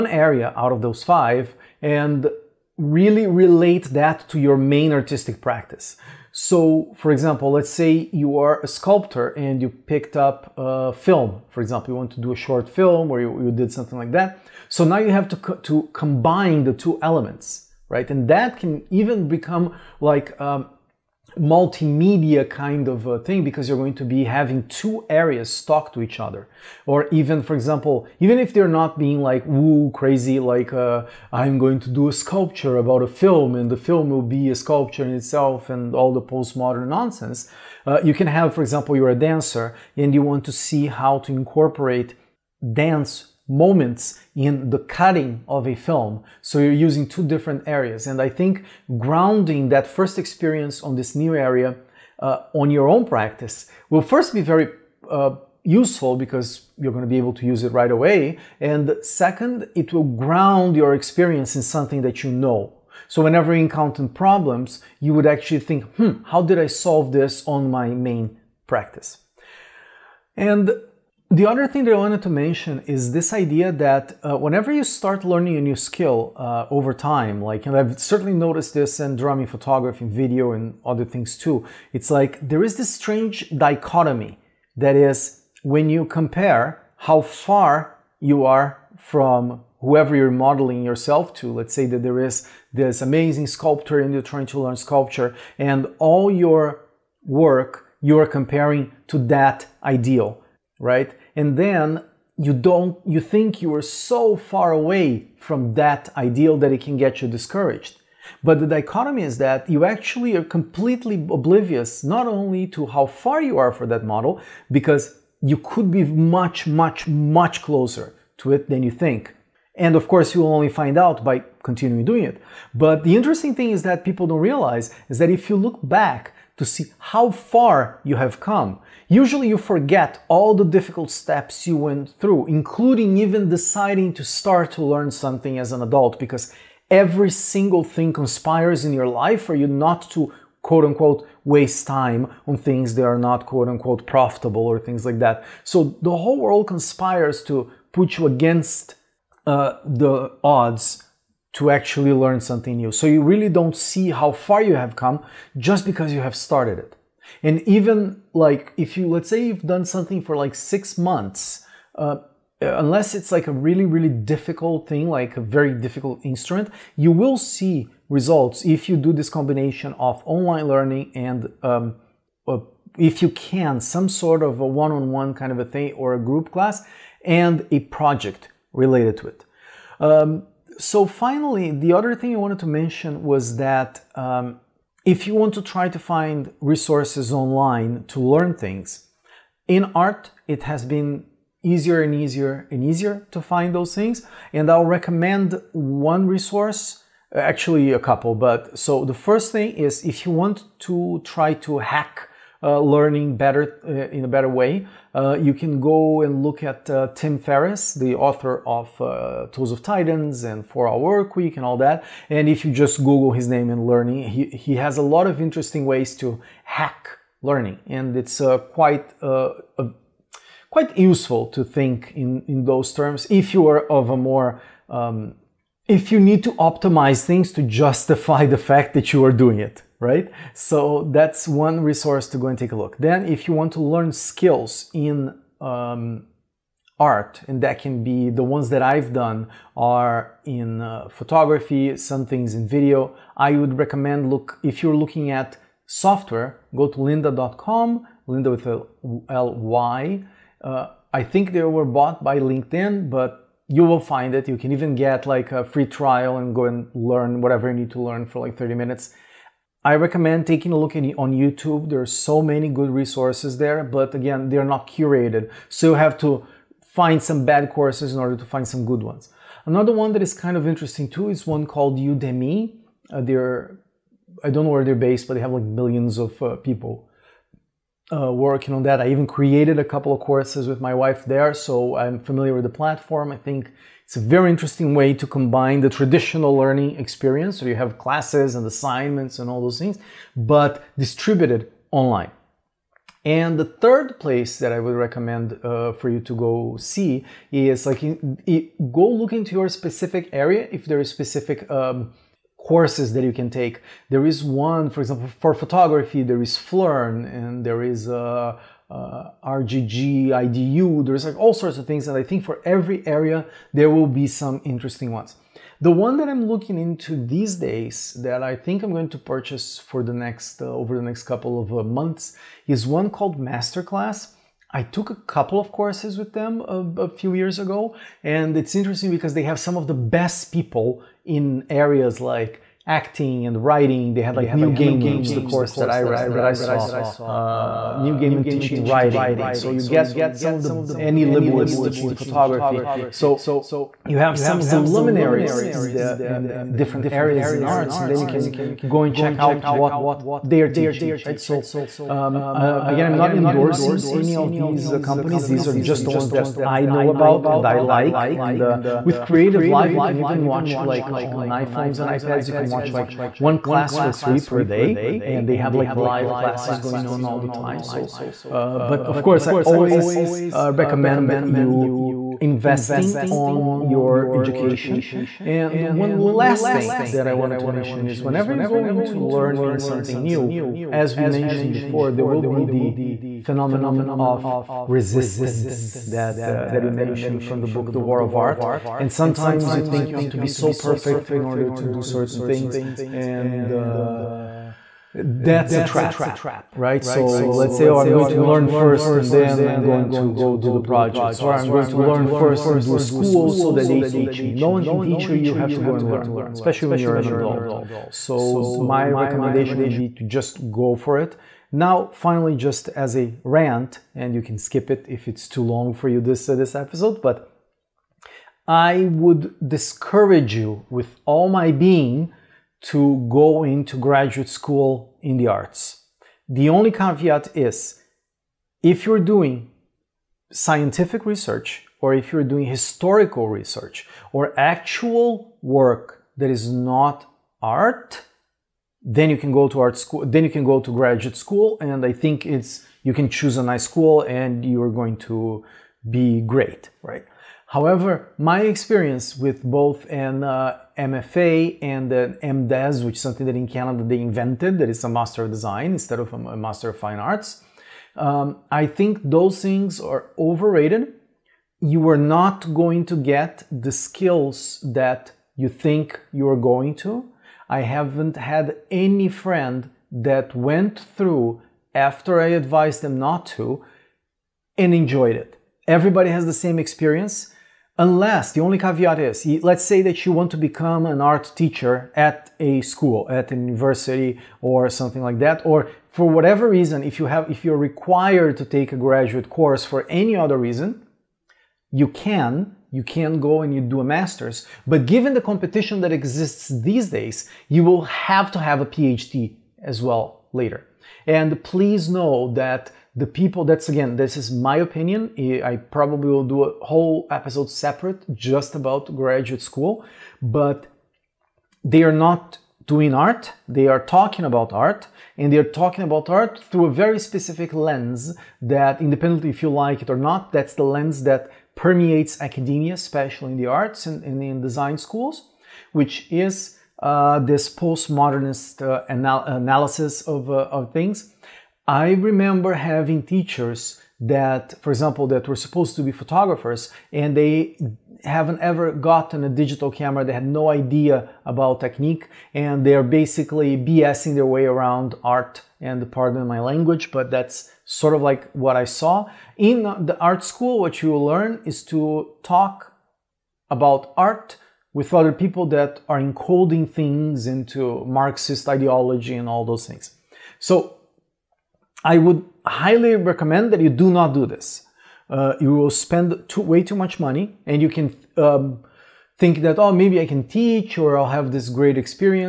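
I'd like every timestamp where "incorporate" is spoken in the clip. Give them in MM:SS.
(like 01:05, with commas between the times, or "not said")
00:41.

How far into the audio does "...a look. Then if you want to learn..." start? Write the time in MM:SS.
03:52.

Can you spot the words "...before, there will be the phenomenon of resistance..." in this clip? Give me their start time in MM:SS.
06:21.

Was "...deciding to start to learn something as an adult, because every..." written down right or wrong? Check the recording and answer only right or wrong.
right.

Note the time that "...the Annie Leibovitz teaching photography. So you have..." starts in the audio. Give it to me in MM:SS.
05:40.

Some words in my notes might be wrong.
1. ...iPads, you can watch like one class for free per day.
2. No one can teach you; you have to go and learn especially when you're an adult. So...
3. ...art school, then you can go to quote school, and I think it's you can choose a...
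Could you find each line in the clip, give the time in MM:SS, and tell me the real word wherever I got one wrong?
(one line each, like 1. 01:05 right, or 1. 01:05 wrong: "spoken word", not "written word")
1. 06:02 right
2. 06:44 right
3. 07:19 wrong: "graduate", not "quote".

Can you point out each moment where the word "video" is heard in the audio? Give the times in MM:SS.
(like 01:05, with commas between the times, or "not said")
01:20, 04:02.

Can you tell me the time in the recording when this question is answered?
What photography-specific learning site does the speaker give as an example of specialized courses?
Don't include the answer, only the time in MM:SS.
05:06.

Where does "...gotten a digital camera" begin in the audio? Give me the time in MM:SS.
08:58.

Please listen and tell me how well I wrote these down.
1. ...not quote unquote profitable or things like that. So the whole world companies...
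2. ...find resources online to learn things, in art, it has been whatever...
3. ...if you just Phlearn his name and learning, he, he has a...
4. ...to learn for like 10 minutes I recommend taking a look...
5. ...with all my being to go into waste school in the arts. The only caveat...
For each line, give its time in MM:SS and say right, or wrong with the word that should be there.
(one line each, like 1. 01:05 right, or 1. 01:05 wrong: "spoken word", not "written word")
1. 02:23 wrong: "conspires", not "companies"
2. 03:05 wrong: "easier", not "whatever"
3. 03:32 wrong: "Google", not "Phlearn"
4. 04:17 wrong: "30", not "10"
5. 07:00 wrong: "graduate", not "waste".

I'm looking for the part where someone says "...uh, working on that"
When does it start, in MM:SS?
04:38.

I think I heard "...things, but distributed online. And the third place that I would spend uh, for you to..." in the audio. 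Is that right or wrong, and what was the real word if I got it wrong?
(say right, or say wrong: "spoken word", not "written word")
wrong: "recommend", not "spend".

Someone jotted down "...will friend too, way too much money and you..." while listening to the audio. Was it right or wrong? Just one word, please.
wrong.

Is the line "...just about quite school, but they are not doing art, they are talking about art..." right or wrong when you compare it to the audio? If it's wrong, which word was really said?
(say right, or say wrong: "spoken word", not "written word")
wrong: "graduate", not "quite".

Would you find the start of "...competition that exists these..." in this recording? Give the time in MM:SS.
08:15.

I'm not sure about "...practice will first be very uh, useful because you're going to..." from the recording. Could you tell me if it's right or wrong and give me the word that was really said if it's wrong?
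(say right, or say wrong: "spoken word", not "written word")
right.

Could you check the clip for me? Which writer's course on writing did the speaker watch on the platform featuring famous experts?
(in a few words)
Neil Gaiman.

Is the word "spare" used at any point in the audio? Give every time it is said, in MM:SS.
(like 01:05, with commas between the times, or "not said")
not said.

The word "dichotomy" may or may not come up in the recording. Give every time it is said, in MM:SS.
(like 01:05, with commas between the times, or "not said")
01:23, 01:48.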